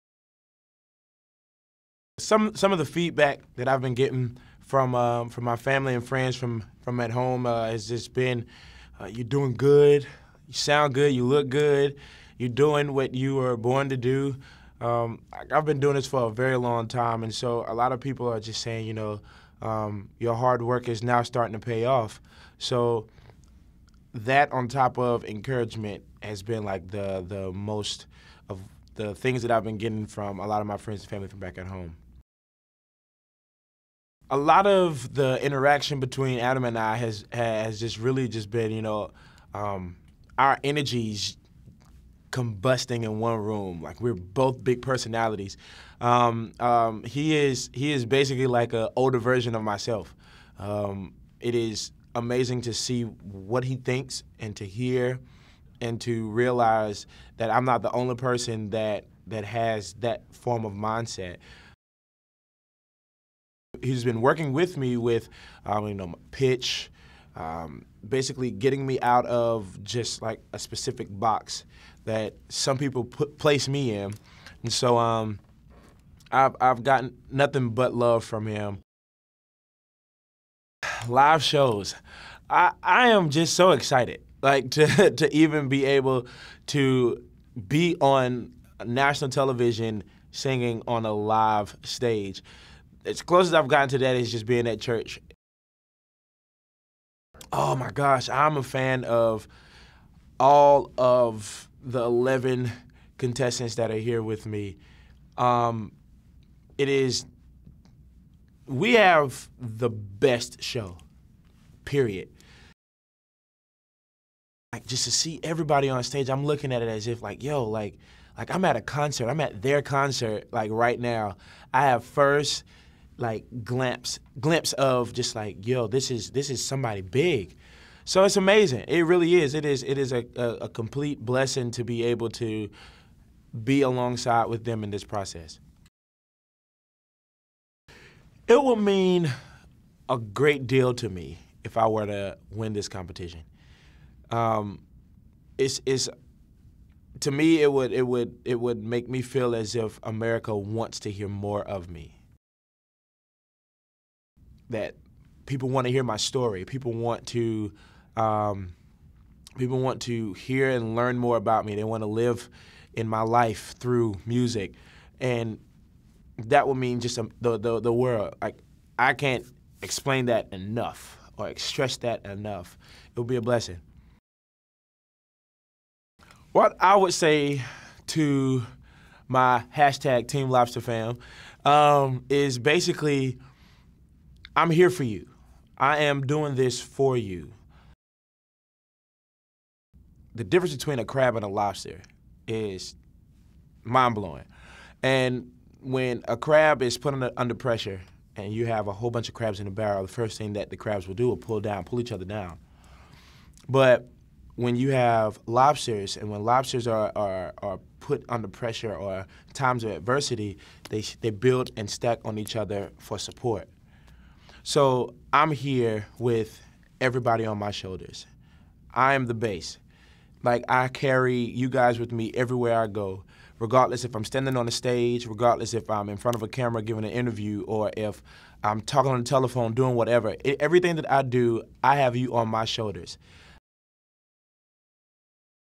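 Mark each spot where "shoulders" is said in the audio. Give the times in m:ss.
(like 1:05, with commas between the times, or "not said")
3:37, 3:52.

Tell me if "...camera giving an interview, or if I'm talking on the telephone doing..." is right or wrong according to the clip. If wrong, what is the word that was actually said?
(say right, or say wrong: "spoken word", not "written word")
right.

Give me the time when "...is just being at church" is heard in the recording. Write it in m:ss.
1:34.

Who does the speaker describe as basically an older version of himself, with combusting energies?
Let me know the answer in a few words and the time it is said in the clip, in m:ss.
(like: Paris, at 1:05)
Adam, at 0:36.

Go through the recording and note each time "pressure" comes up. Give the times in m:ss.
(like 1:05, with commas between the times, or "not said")
3:17, 3:28.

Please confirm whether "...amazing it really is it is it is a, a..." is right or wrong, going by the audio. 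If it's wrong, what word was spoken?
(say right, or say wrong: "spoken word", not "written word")
right.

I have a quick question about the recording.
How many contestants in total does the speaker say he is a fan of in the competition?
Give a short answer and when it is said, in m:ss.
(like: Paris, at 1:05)
11, at 1:42.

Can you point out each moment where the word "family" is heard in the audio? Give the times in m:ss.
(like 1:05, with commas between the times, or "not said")
0:05, 0:31.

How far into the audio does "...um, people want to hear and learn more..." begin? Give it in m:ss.
2:38.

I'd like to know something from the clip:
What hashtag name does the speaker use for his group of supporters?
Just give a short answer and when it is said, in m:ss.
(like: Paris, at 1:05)
Team Lobster Fam, at 3:00.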